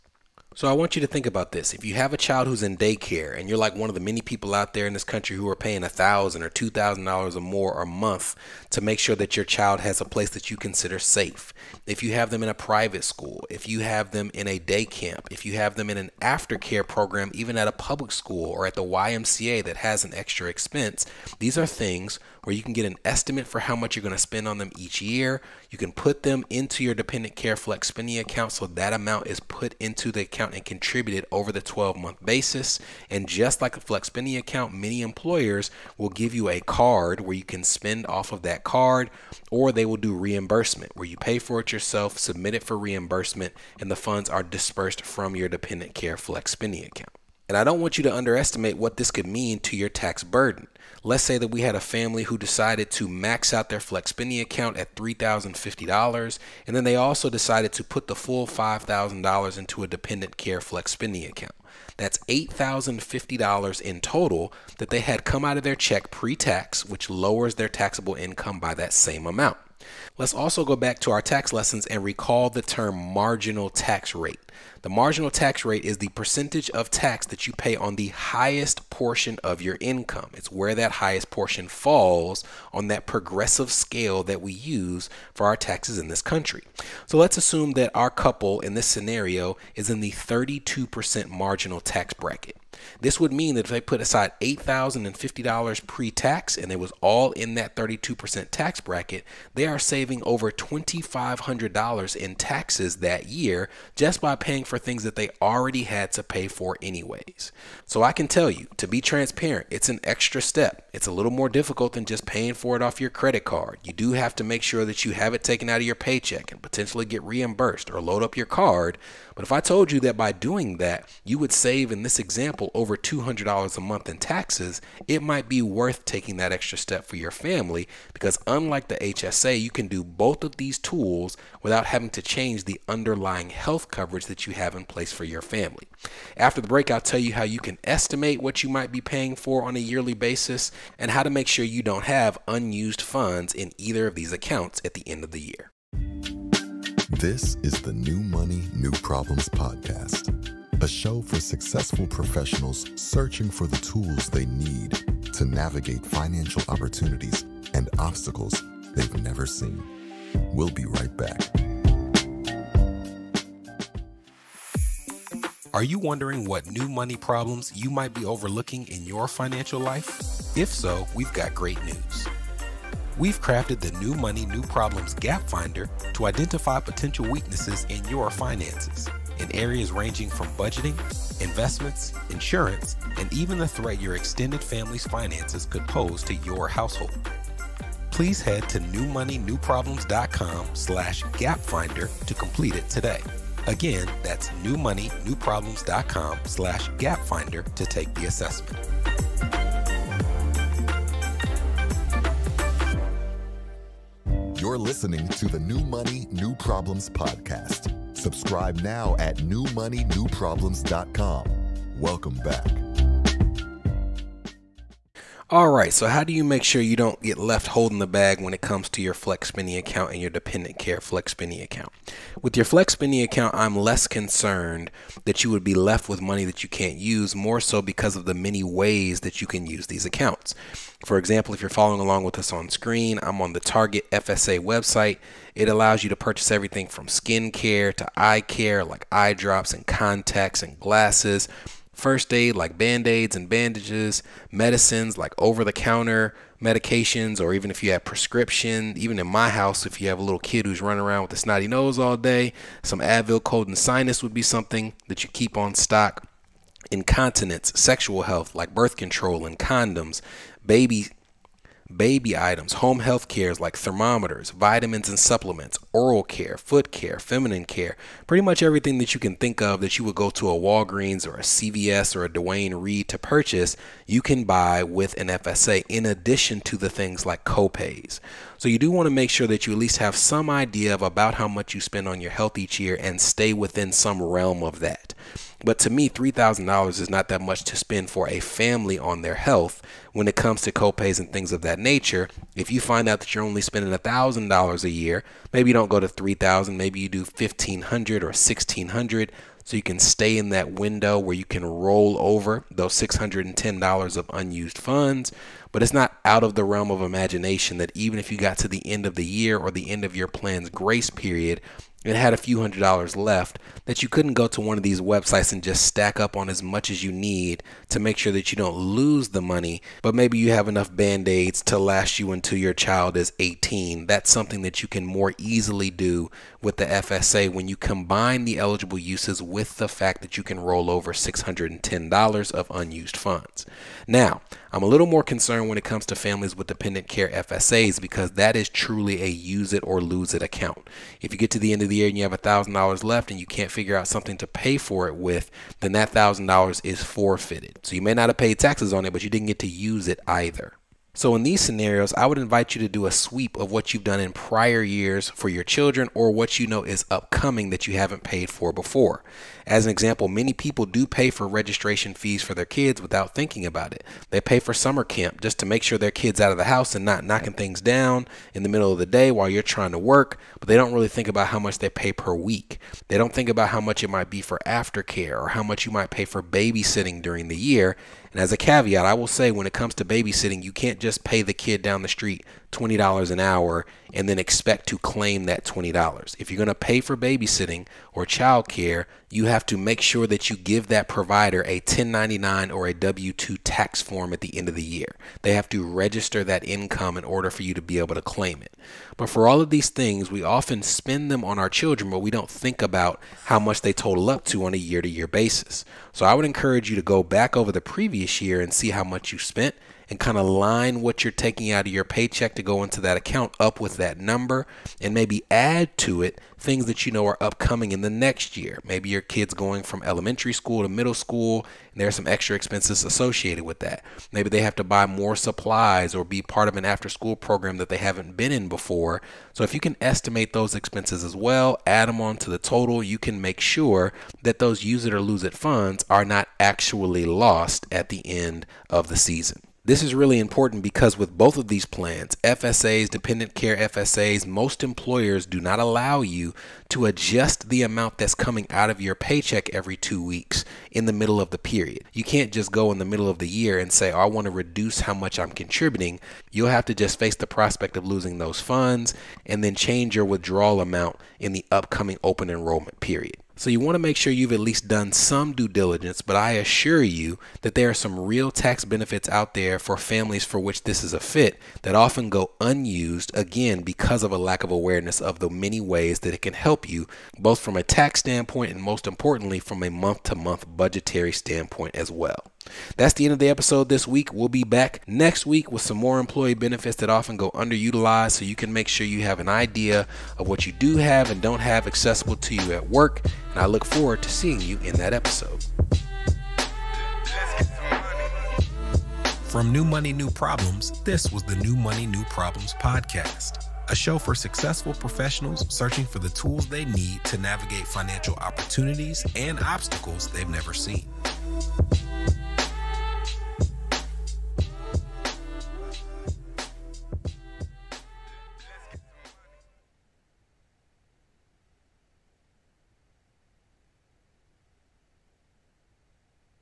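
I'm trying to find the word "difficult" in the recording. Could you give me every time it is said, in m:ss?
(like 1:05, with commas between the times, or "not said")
1:51.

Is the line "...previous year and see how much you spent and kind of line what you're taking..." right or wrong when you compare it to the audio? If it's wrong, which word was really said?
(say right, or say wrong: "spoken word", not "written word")
right.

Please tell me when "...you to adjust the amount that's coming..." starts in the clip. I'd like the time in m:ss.
7:26.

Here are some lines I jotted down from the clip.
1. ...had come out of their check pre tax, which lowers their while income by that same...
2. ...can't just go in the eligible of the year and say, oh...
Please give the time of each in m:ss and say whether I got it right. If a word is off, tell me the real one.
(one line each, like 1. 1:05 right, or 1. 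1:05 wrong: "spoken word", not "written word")
1. 1:04 wrong: "taxable", not "while"
2. 7:32 wrong: "middle", not "eligible".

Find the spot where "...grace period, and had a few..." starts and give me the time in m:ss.
5:10.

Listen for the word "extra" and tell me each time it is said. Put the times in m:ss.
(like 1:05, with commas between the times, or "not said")
0:20, 1:50, 2:06, 7:02.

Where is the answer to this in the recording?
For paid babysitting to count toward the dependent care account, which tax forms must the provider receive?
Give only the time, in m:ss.
6:31.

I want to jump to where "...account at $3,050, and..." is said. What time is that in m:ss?
0:54.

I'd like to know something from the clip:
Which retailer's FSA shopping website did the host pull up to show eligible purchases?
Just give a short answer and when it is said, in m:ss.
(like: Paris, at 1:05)
Target, at 3:53.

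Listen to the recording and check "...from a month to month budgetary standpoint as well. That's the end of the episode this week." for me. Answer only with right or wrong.
right.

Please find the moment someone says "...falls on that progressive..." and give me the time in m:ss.
1:21.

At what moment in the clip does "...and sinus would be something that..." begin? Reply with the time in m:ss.
4:13.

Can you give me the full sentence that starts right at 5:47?
So you may not have paid taxes on it, but you didn't get to use it either.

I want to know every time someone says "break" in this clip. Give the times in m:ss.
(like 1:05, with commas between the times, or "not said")
2:16.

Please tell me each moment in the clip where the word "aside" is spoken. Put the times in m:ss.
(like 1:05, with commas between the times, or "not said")
1:34.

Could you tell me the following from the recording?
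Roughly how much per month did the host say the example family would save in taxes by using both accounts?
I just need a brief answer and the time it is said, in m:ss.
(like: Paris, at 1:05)
over $200, at 2:02.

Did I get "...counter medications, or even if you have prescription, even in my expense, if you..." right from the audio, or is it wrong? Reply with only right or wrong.
wrong.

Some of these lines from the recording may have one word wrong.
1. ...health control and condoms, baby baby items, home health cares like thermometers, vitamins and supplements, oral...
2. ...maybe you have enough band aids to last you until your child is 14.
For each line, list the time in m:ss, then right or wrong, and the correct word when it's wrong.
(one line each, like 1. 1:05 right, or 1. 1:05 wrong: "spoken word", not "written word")
1. 4:18 wrong: "birth", not "health"
2. 5:20 wrong: "18", not "14".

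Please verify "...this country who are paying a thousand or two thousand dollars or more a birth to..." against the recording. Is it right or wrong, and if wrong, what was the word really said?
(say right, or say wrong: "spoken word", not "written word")
wrong: "month", not "birth".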